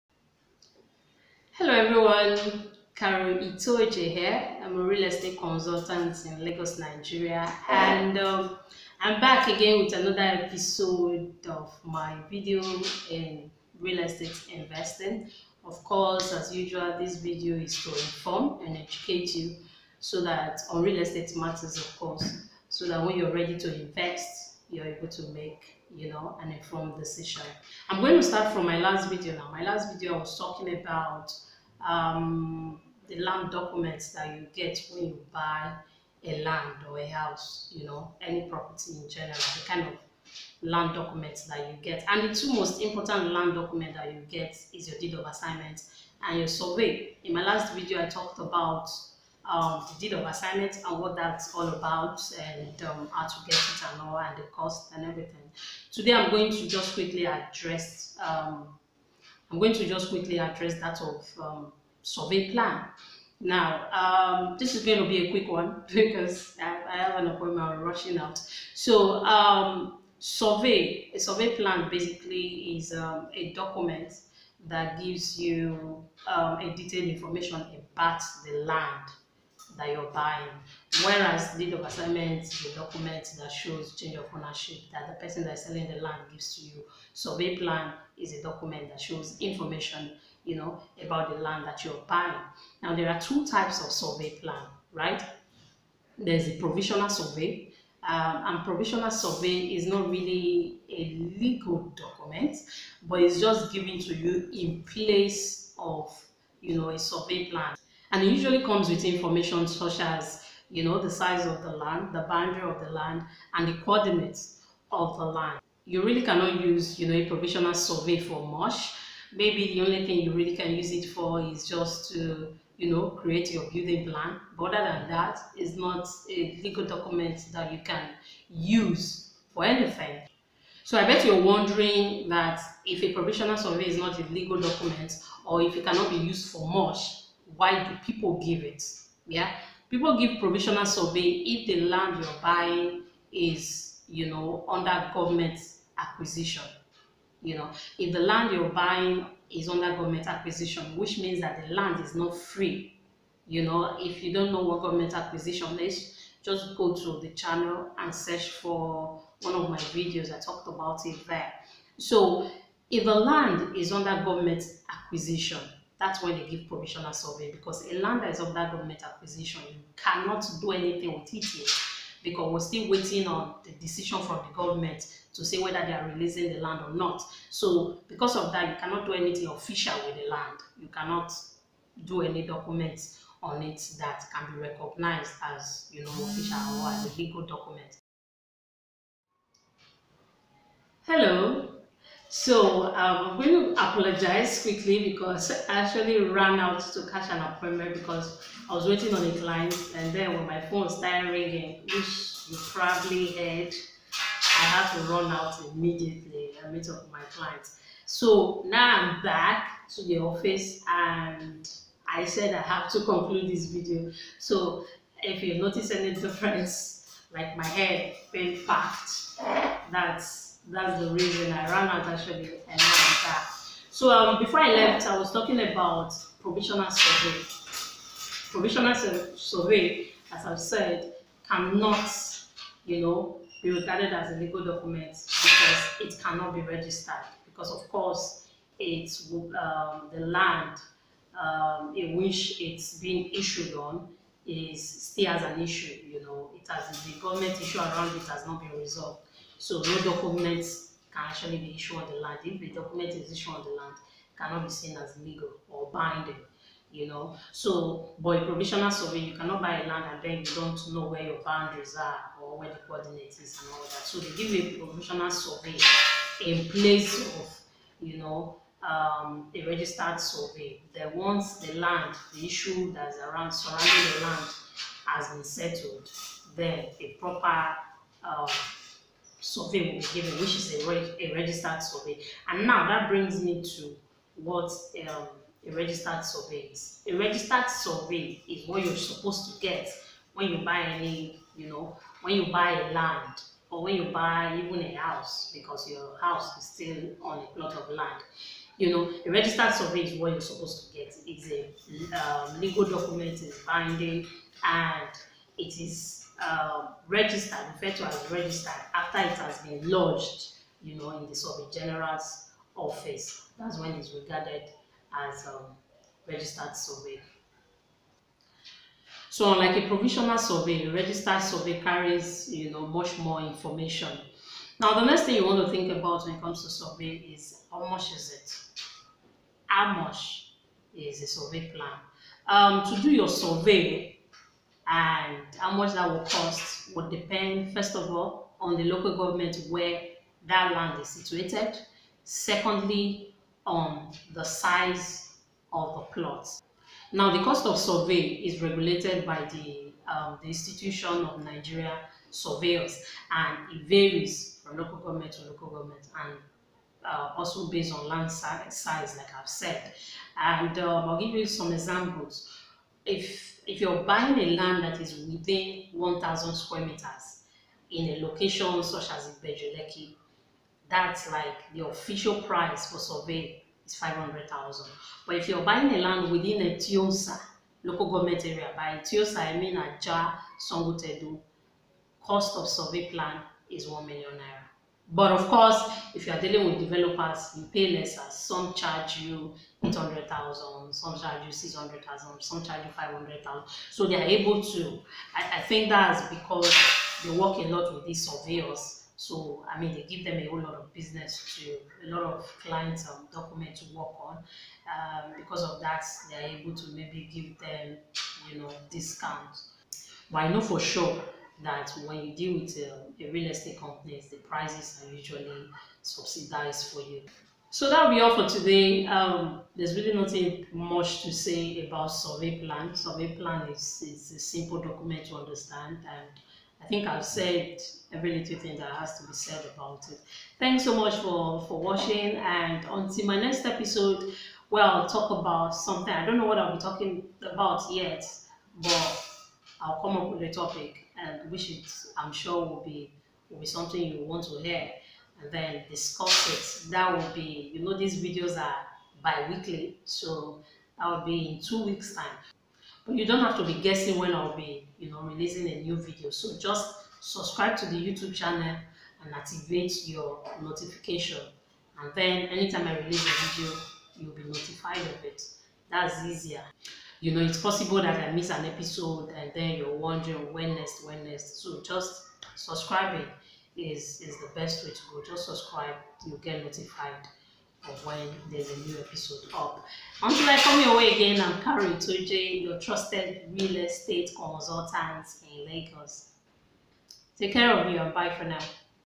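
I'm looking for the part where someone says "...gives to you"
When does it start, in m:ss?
1:26.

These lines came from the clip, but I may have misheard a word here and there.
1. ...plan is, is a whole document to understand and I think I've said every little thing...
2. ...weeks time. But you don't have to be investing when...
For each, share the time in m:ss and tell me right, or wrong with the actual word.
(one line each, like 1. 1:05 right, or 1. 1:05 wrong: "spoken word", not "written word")
1. 7:03 wrong: "simple", not "whole"
2. 7:31 wrong: "guessing", not "investing".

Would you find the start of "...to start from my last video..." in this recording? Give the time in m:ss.
0:28.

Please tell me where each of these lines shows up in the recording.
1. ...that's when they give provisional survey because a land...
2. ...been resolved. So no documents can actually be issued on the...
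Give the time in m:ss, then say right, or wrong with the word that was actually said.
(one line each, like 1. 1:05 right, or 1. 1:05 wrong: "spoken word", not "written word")
1. 2:46 right
2. 4:08 right.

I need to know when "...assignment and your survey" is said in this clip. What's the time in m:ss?
0:45.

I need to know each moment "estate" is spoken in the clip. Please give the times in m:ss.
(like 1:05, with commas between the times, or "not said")
0:05, 0:13, 0:20, 6:53, 8:03.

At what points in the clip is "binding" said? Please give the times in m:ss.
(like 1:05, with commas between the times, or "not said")
4:15, 5:03.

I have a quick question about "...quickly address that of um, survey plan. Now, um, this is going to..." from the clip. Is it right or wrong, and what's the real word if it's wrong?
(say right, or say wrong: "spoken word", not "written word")
right.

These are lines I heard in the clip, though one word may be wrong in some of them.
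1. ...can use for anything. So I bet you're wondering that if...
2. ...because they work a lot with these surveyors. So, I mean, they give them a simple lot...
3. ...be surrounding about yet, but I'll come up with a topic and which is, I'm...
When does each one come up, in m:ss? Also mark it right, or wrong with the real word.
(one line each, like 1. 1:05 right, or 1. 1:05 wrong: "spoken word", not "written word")
1. 2:07 right
2. 6:36 wrong: "whole", not "simple"
3. 7:16 wrong: "talking", not "surrounding".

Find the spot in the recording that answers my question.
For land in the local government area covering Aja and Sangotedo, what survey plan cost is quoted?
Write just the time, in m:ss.
6:23.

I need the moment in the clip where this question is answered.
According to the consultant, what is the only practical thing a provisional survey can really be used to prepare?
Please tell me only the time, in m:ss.
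2:03.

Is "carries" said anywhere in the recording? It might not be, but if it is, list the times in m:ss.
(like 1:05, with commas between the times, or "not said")
5:21, 8:01.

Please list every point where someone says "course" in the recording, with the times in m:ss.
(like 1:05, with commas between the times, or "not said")
0:15, 0:21, 3:57, 6:25.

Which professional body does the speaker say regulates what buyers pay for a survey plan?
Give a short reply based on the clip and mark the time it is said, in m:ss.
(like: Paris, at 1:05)
Institution of Nigeria Surveyors, at 5:50.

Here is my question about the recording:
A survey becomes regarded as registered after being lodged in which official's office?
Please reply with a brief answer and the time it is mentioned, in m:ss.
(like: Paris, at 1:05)
Survey General, at 5:11.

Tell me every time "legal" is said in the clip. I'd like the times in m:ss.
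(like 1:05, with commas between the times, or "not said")
1:41, 2:06, 2:14, 3:07, 3:54, 4:15, 5:02.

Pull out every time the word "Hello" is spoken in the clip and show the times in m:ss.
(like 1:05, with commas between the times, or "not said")
0:01, 3:11.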